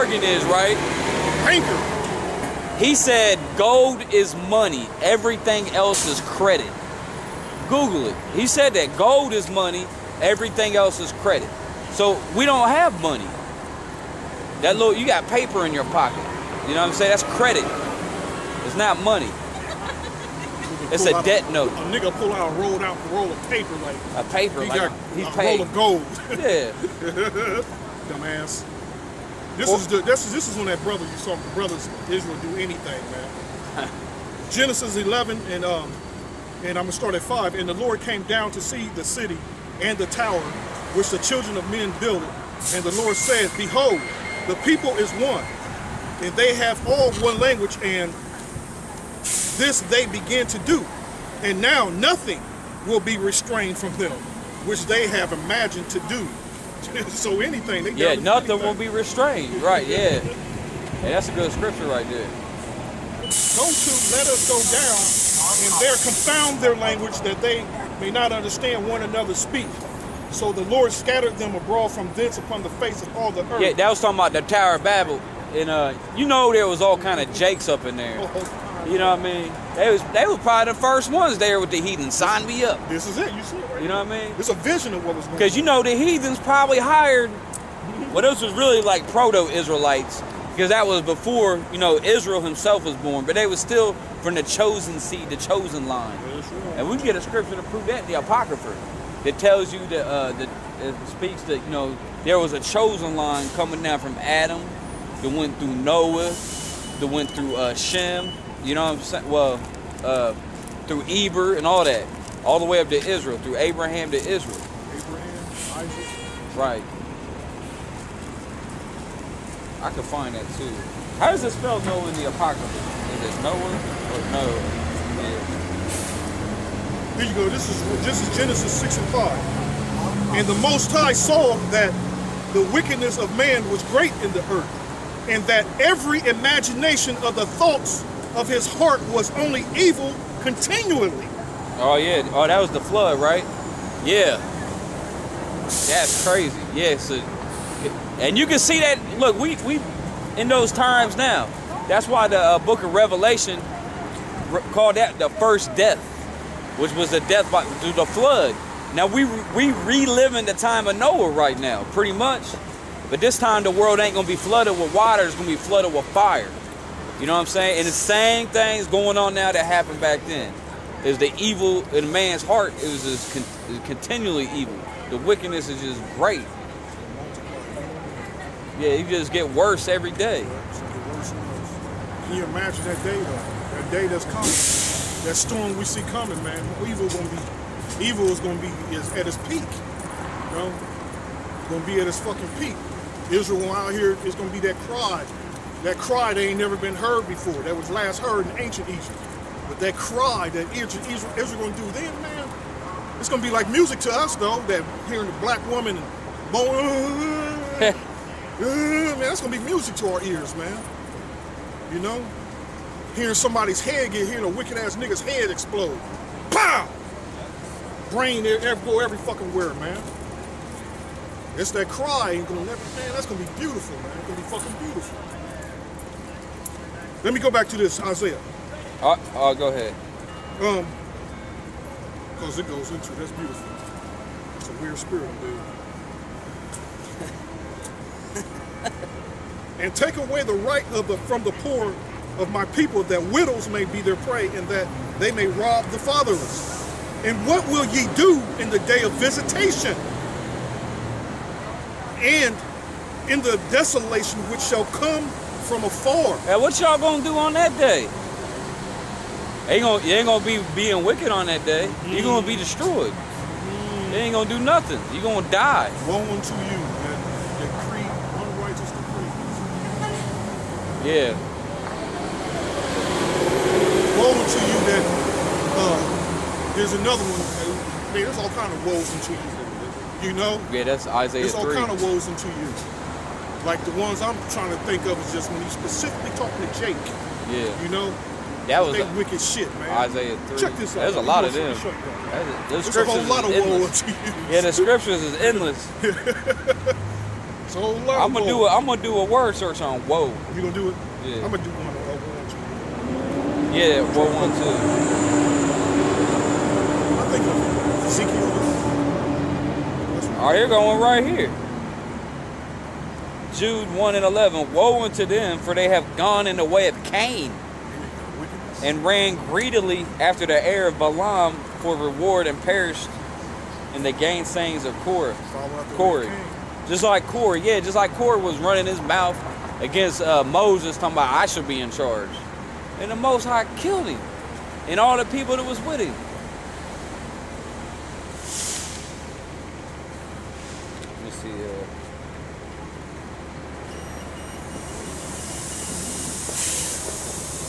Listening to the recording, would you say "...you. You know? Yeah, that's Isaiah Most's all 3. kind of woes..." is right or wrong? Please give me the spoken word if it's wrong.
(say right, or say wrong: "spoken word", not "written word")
wrong: "There", not "Most".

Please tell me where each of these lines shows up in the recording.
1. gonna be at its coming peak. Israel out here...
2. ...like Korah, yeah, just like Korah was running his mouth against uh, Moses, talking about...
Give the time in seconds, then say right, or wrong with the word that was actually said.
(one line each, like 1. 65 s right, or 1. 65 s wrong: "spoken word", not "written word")
1. 191 s wrong: "fucking", not "coming"
2. 327 s right.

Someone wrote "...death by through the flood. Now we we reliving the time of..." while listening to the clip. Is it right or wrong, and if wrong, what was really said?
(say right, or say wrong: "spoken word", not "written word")
right.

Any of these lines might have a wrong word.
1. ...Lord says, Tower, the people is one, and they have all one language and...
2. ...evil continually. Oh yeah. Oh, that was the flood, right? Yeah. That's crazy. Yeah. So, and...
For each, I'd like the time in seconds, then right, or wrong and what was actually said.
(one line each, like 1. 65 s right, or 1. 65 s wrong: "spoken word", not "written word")
1. 43 s wrong: "Behold", not "Tower"
2. 139 s right.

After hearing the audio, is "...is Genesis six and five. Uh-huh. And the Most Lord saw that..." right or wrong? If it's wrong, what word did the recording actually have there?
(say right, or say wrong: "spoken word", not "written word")
wrong: "High", not "Lord".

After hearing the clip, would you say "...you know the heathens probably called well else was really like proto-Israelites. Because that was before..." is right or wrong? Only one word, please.
wrong.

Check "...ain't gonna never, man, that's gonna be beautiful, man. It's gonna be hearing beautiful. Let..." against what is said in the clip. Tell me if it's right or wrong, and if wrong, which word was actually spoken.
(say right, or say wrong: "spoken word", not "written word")
wrong: "fucking", not "hearing".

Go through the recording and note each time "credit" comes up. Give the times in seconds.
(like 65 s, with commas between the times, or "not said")
6 s, 11 s, 17 s.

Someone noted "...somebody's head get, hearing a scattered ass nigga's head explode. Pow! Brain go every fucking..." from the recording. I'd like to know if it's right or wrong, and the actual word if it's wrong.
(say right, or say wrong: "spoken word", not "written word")
wrong: "wicked", not "scattered".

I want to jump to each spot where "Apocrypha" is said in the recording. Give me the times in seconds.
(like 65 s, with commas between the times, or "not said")
98 s, 122 s.